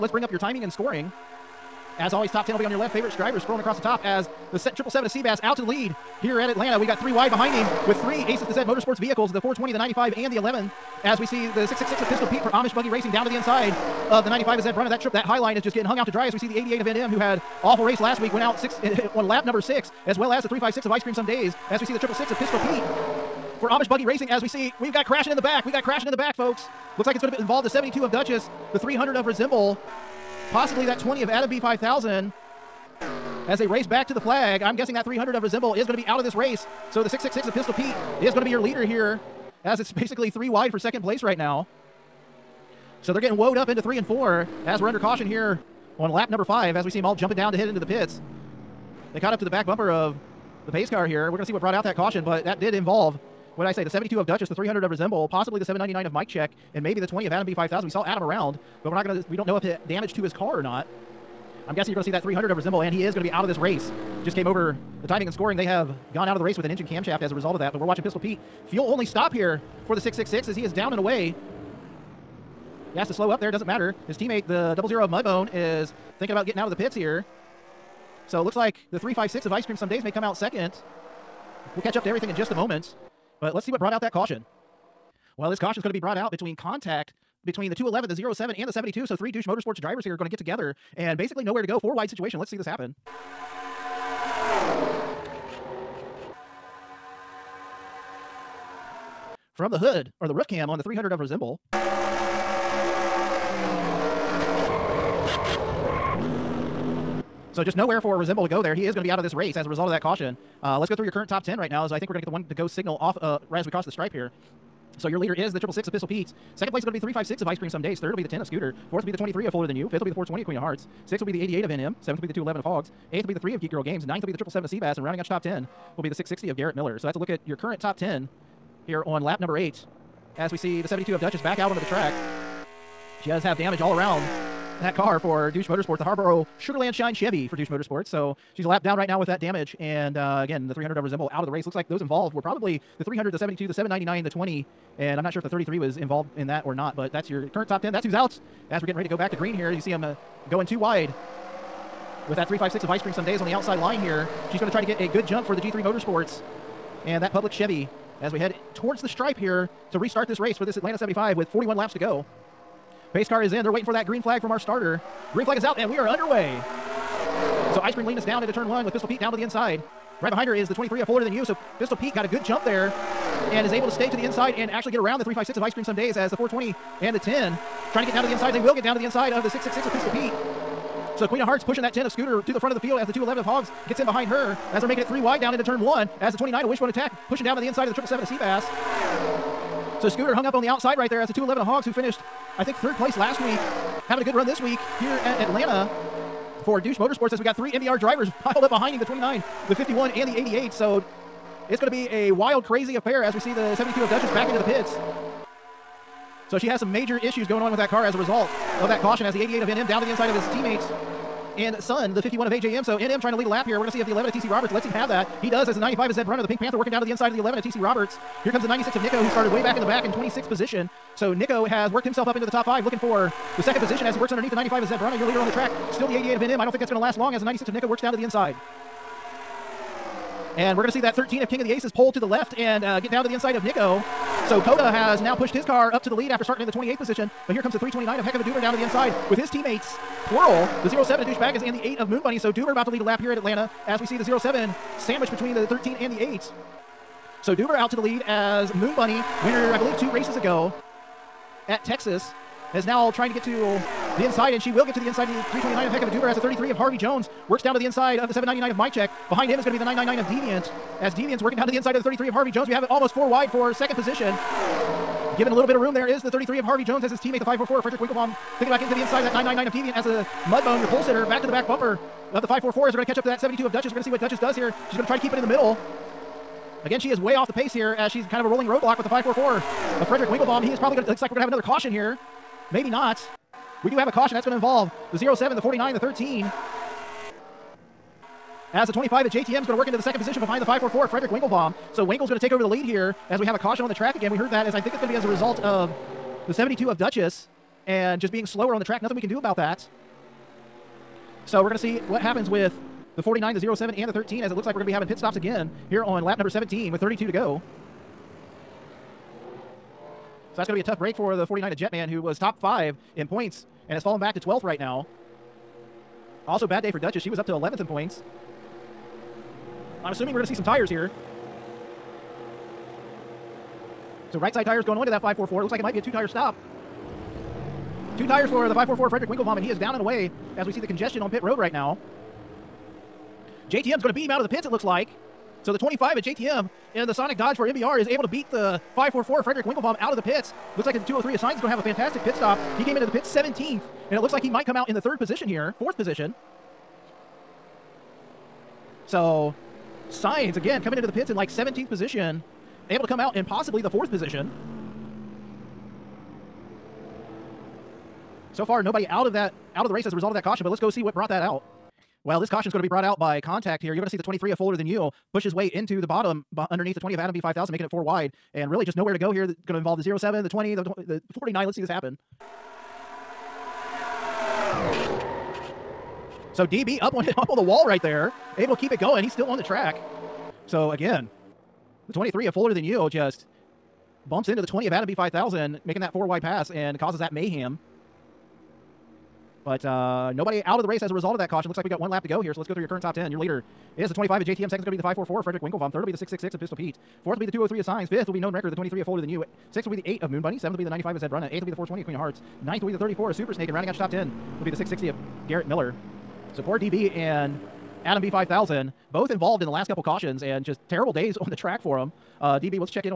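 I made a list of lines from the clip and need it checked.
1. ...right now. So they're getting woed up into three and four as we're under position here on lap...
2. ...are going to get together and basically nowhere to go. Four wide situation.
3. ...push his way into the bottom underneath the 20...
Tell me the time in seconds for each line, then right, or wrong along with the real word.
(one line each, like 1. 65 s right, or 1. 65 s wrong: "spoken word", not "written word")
1. 41 s wrong: "caution", not "position"
2. 90 s right
3. 365 s right.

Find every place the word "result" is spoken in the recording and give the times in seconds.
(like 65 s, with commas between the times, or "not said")
67 s, 109 s, 208 s, 295 s, 360 s, 391 s.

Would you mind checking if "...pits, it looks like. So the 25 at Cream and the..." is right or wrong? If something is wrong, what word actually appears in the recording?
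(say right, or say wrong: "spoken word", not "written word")
wrong: "JTM", not "Cream".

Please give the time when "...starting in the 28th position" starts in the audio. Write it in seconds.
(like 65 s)
236 s.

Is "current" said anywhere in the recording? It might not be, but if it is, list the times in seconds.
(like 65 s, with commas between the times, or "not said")
111 s, 127 s, 147 s, 392 s.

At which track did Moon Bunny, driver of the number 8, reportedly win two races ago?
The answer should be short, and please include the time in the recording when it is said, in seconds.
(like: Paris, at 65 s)
Texas, at 251 s.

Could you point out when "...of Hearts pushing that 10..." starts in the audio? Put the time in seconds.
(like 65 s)
181 s.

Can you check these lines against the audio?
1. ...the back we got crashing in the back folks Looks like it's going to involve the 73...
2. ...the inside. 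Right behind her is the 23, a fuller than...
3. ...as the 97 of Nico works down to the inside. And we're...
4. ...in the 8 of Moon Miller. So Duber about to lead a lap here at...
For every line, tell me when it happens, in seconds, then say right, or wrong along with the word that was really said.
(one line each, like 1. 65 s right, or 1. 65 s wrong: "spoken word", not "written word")
1. 25 s wrong: "72", not "73"
2. 169 s right
3. 227 s wrong: "96", not "97"
4. 241 s wrong: "Bunny", not "Miller".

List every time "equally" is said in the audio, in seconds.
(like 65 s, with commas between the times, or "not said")
not said.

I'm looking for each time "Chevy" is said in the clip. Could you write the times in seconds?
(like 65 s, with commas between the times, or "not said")
137 s, 157 s.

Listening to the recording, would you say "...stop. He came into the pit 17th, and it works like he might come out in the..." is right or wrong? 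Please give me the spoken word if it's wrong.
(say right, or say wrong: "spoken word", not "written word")
wrong: "looks", not "works".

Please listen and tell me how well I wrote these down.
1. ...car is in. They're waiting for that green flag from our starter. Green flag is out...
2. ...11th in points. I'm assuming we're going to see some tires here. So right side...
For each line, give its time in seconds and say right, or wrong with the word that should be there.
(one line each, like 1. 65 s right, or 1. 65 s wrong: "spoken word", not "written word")
1. 163 s right
2. 317 s right.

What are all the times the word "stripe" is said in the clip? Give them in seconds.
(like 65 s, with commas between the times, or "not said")
113 s, 159 s.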